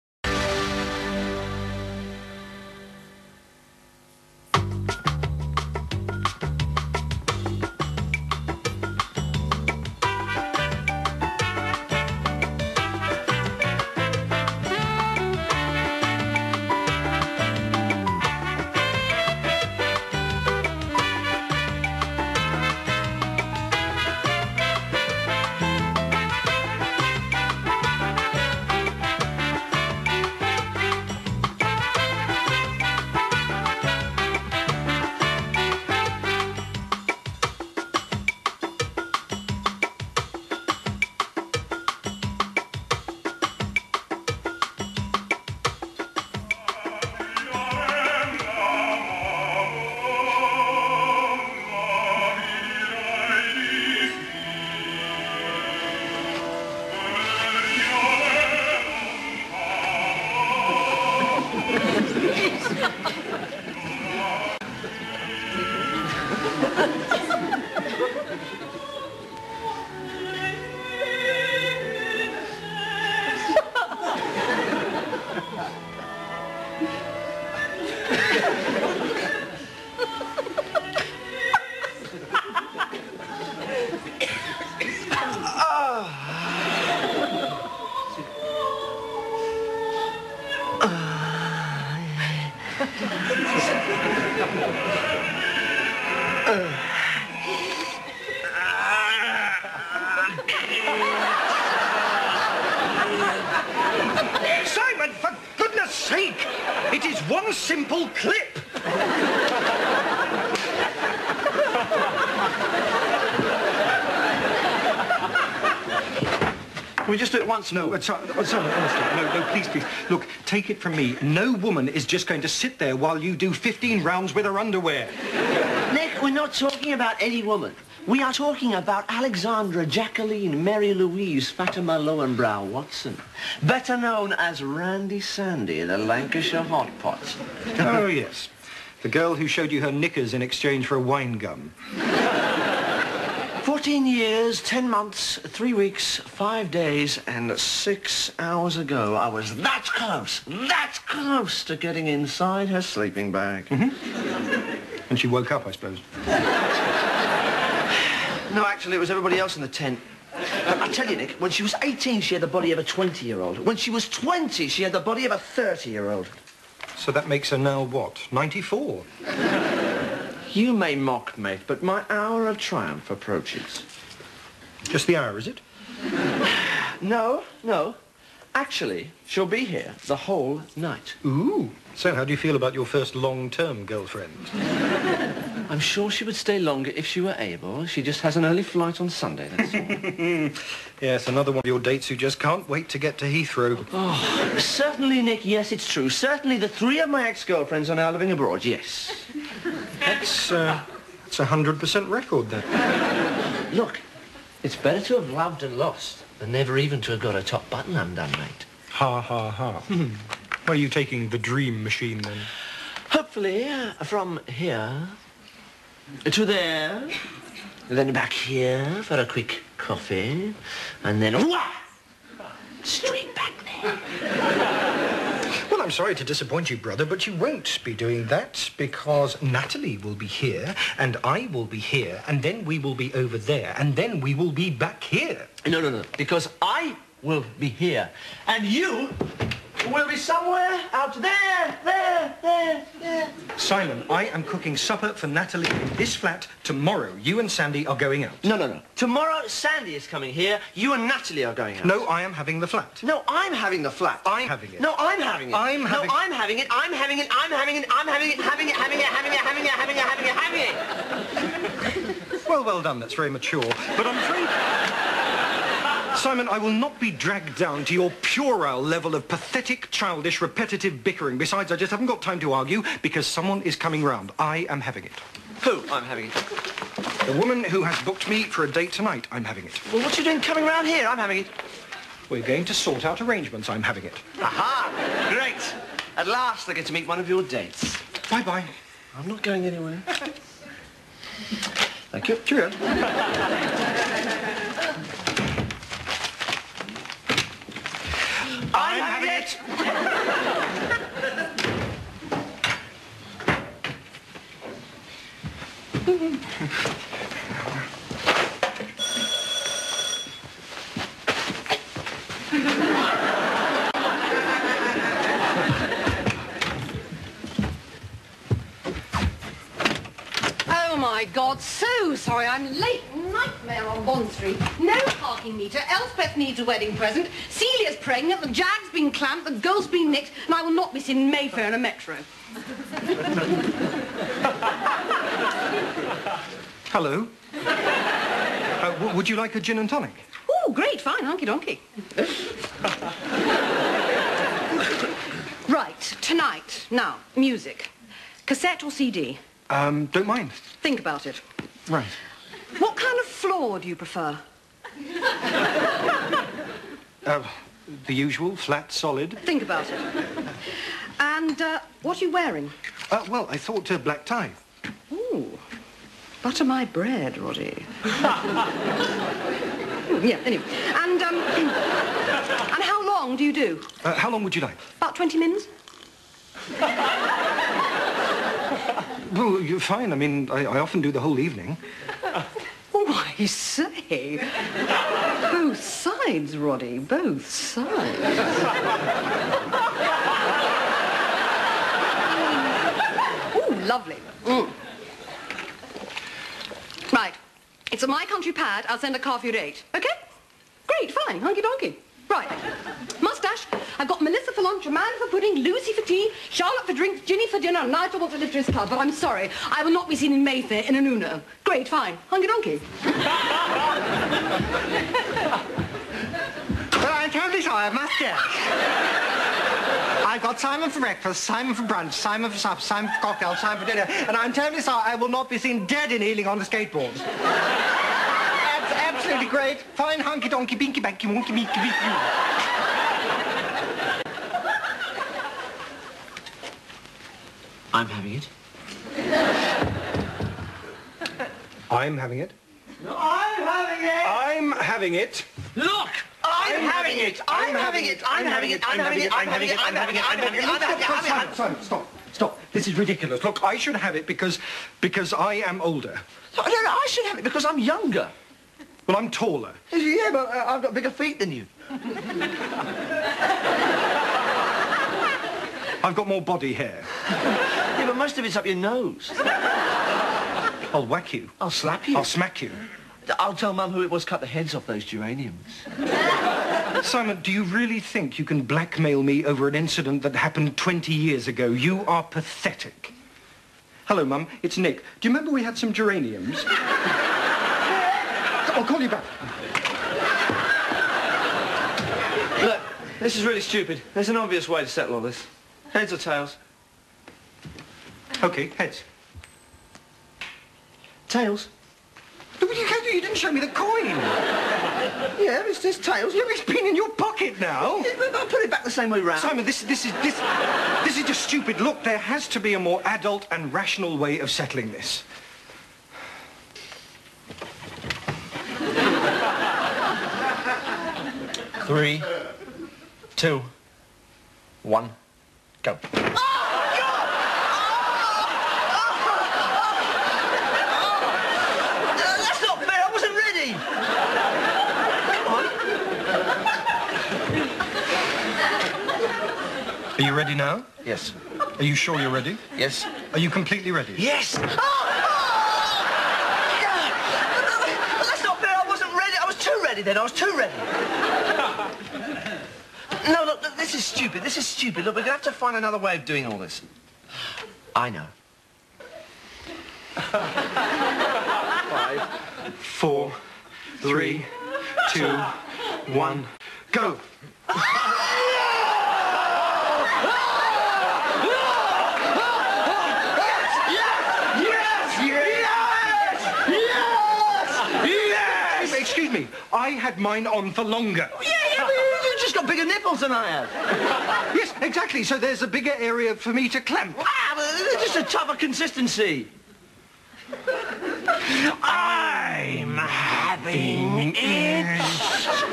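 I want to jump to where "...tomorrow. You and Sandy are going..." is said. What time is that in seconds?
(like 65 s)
246 s.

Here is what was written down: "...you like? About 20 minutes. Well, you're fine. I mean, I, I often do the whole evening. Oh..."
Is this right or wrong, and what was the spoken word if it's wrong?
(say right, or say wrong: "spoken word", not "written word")
right.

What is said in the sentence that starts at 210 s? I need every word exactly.
Where are you taking the dream machine, then?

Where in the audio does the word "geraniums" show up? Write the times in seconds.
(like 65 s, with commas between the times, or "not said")
475 s, 485 s.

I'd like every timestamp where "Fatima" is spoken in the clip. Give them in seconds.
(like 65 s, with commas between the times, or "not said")
131 s.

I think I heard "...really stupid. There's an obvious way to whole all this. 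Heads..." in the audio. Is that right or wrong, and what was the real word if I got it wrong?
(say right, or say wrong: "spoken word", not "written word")
wrong: "settle", not "whole".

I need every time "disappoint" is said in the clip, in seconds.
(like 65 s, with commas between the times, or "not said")
226 s.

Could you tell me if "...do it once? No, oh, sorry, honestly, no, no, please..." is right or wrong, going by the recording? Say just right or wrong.
right.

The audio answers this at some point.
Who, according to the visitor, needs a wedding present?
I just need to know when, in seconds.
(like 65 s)
325 s.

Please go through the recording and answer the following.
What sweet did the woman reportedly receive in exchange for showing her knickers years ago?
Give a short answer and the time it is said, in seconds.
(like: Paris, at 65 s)
A wine gum, at 140 s.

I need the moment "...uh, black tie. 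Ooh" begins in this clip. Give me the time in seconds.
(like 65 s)
363 s.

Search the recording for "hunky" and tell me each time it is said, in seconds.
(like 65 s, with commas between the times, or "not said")
341 s, 401 s, 412 s, 430 s.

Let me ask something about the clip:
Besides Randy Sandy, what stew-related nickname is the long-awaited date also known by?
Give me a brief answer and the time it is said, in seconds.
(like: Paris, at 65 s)
The Lancashire Hot Pot, at 135 s.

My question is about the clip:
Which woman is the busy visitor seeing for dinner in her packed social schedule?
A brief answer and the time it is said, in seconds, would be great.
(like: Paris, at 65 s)
Ginny, at 407 s.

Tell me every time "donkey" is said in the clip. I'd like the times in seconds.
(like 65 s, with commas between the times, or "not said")
341 s, 401 s, 412 s, 430 s.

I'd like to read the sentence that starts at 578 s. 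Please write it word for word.
Excuse me, I had mine on for longer.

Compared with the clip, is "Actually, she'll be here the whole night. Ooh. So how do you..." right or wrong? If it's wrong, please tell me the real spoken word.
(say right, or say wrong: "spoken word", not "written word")
right.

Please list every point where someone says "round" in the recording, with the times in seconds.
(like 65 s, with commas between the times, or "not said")
124 s, 274 s, 280 s, 509 s.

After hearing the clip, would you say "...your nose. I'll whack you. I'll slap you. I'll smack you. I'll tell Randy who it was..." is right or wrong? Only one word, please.
wrong.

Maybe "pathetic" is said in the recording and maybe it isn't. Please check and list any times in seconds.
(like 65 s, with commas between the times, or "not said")
269 s, 482 s.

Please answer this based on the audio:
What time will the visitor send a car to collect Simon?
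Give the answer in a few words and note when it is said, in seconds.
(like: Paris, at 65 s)
8, at 399 s.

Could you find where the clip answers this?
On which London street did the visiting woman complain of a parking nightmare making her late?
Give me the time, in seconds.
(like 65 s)
324 s.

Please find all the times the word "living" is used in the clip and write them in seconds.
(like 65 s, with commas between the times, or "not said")
198 s.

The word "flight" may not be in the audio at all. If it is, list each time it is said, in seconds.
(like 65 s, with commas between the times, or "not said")
188 s.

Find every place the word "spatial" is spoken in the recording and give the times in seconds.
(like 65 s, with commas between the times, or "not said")
not said.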